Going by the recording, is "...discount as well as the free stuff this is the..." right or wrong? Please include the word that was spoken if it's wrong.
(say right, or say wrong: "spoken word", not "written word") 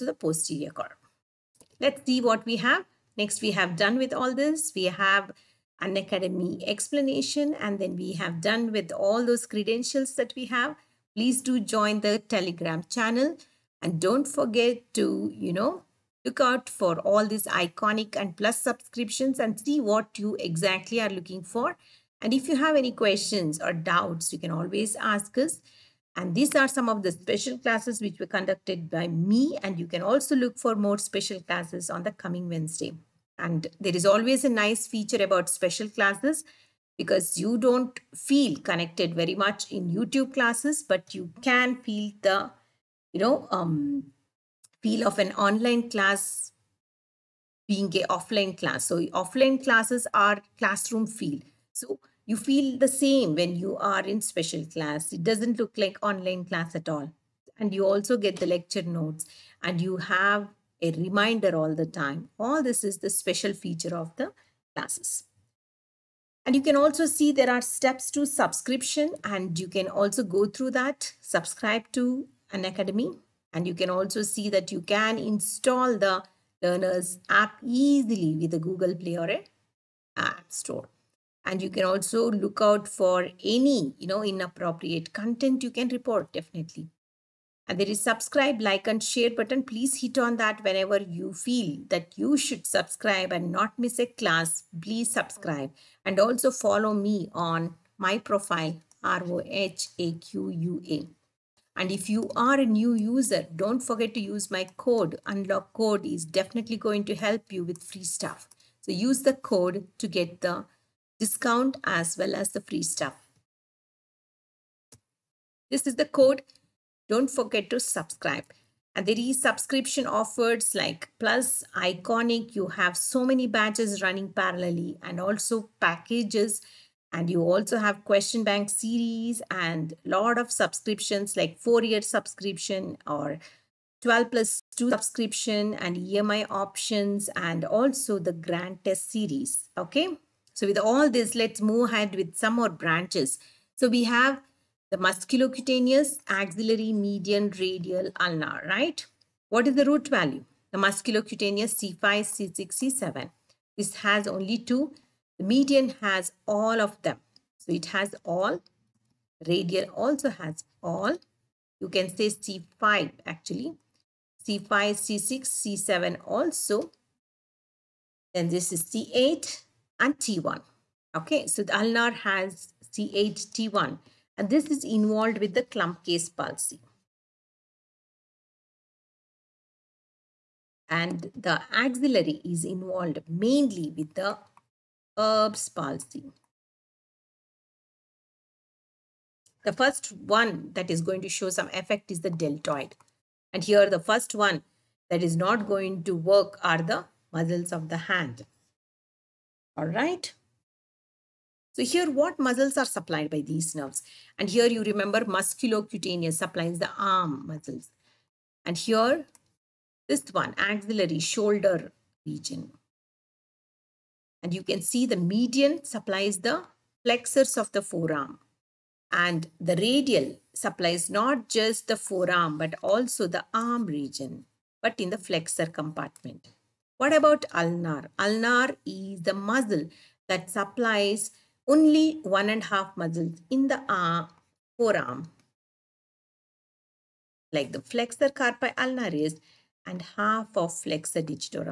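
right.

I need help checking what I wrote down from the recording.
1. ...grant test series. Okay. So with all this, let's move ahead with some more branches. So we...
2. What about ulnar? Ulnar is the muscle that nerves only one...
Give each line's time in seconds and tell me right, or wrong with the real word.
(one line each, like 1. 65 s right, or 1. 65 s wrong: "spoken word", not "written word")
1. 138 s right
2. 226 s wrong: "supplies", not "nerves".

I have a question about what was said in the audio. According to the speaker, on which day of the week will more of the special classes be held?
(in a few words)
Wednesday.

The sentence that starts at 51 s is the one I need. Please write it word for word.
So you feel the same when you are in special class.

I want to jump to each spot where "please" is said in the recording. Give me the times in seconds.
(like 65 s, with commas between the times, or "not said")
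11 s, 89 s, 94 s.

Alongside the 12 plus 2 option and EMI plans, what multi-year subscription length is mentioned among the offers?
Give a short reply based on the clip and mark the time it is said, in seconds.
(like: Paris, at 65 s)
4-year subscription, at 131 s.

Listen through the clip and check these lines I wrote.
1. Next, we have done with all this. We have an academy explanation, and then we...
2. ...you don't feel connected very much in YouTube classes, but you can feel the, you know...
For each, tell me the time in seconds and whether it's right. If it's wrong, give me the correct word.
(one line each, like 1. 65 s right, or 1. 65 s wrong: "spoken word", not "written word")
1. 3 s right
2. 37 s right.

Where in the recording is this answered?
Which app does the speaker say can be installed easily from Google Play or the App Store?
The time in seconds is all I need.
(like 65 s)
76 s.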